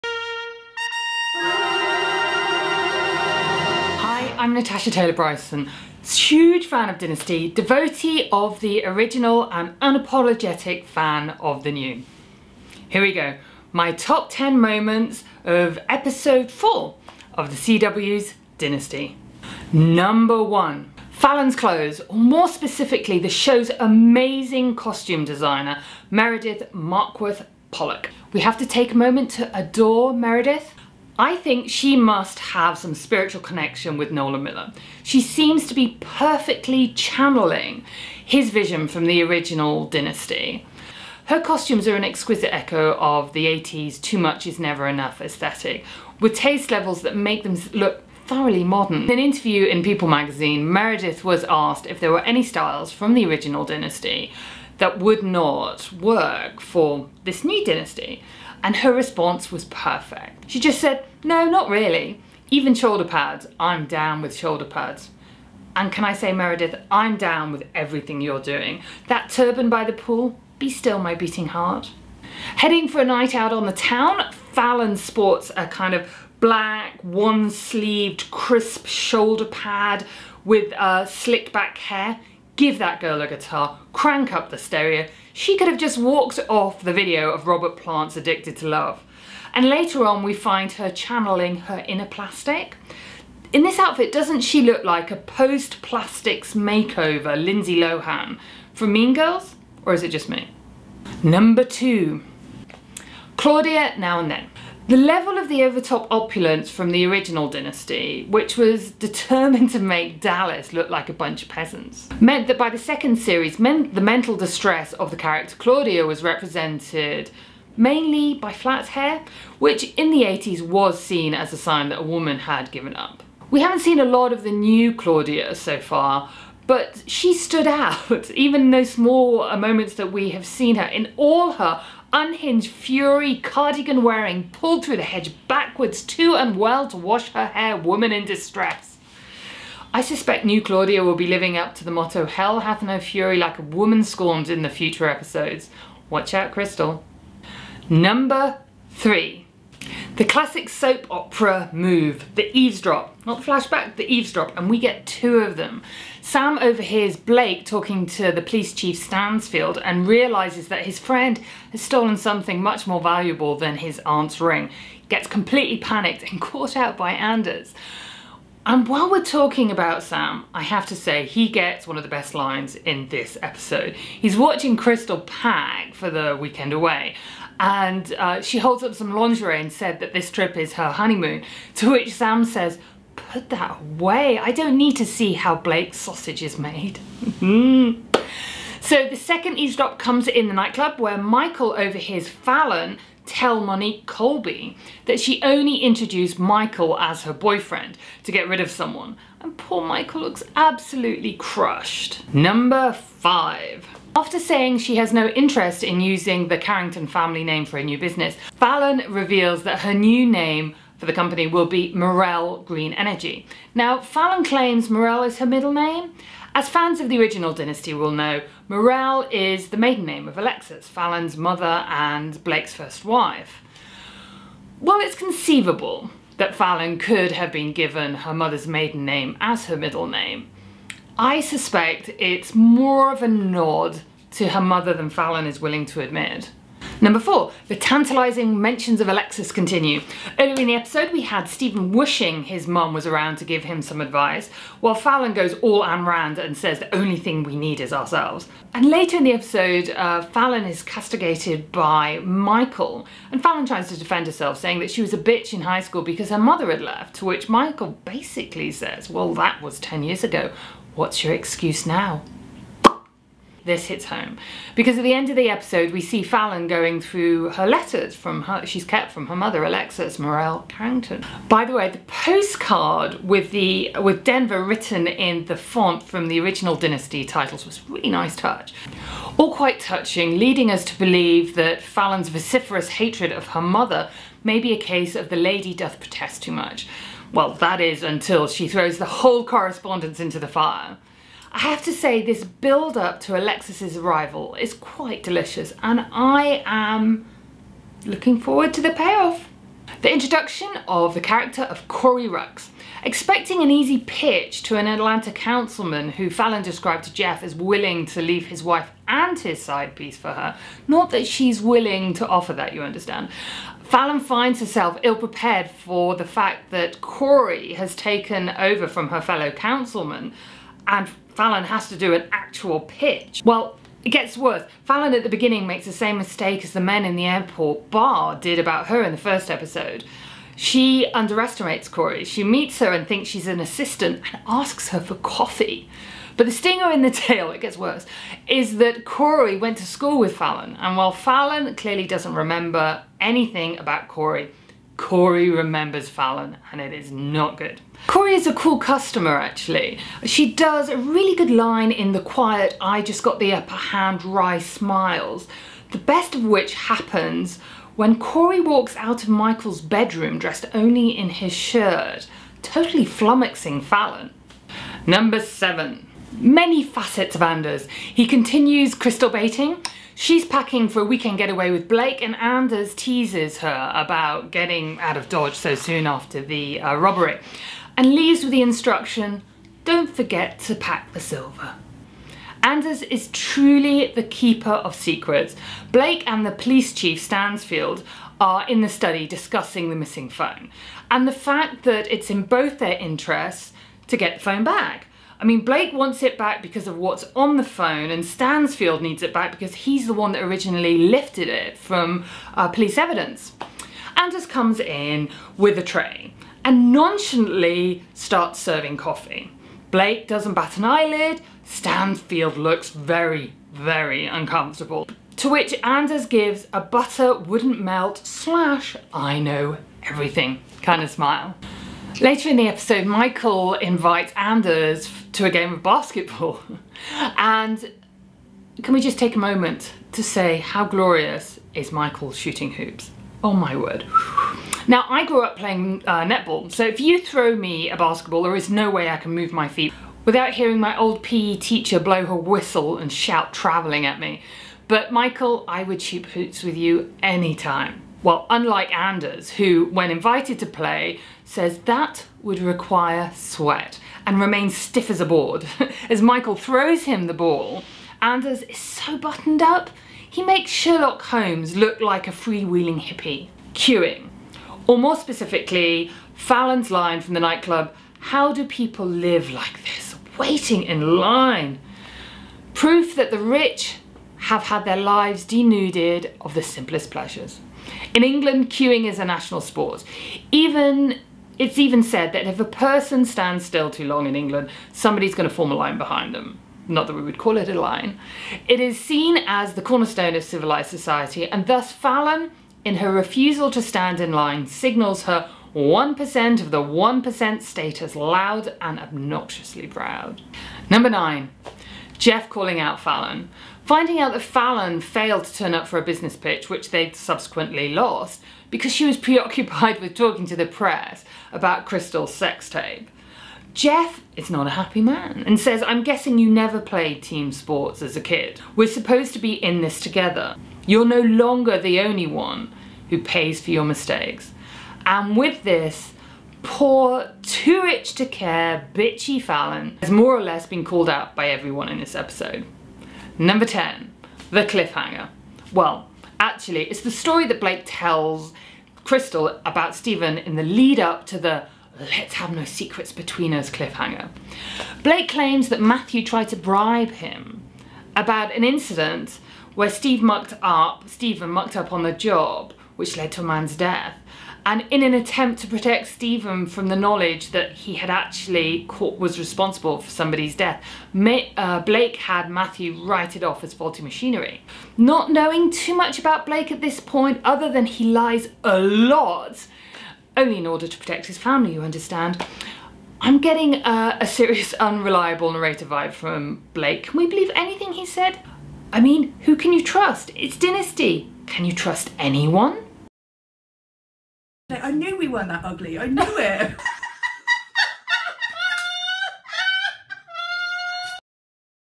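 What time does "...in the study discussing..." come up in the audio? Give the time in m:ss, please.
6:28.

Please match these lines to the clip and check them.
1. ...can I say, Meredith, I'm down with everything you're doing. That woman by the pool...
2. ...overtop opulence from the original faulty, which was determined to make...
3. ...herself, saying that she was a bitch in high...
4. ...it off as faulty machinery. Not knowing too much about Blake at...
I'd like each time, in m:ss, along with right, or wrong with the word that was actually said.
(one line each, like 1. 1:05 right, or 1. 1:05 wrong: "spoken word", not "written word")
1. 1:05 wrong: "turban", not "woman"
2. 1:45 wrong: "dynasty", not "faulty"
3. 4:14 right
4. 9:23 right.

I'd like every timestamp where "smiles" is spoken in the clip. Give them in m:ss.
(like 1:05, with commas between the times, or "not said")
5:54, 7:01.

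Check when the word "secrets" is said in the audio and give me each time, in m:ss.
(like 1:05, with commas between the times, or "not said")
6:24, 9:02.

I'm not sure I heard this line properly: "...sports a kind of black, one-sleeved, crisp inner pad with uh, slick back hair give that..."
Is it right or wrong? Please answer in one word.
wrong.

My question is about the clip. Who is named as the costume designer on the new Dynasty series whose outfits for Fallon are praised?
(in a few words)
Meredith Markworth Pollock.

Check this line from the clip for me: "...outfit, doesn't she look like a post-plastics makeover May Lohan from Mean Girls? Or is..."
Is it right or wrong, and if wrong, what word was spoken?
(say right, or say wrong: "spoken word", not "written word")
wrong: "Lindsay", not "May".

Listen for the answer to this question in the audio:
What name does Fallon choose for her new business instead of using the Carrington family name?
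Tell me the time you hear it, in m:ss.
3:31.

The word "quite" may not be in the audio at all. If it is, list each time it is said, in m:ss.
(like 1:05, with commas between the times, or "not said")
4:39, 4:54.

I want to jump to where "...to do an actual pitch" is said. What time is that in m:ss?
5:21.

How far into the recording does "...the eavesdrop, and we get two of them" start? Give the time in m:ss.
2:33.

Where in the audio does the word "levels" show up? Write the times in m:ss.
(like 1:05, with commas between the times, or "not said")
0:46, 1:44.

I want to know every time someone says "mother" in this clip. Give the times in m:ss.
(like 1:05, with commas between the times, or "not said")
3:41, 3:48, 3:54, 4:16, 4:29, 4:43.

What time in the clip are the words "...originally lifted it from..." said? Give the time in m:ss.
6:40.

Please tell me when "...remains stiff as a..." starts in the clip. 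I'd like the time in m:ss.
7:34.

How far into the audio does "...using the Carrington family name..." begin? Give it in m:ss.
3:26.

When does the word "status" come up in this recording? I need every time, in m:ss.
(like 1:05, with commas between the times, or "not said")
8:17.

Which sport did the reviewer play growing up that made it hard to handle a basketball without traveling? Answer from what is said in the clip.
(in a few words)
netball.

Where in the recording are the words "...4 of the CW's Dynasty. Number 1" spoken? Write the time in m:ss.
0:16.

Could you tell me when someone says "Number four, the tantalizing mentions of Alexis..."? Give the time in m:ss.
3:57.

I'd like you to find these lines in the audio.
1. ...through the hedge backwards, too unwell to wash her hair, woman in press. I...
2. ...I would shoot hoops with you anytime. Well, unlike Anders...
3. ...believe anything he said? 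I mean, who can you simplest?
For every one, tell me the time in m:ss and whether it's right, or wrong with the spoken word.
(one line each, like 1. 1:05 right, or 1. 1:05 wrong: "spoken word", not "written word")
1. 2:14 wrong: "distress", not "press"
2. 7:25 right
3. 9:37 wrong: "trust", not "simplest".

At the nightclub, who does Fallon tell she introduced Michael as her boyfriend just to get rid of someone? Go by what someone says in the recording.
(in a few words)
Monique Colby.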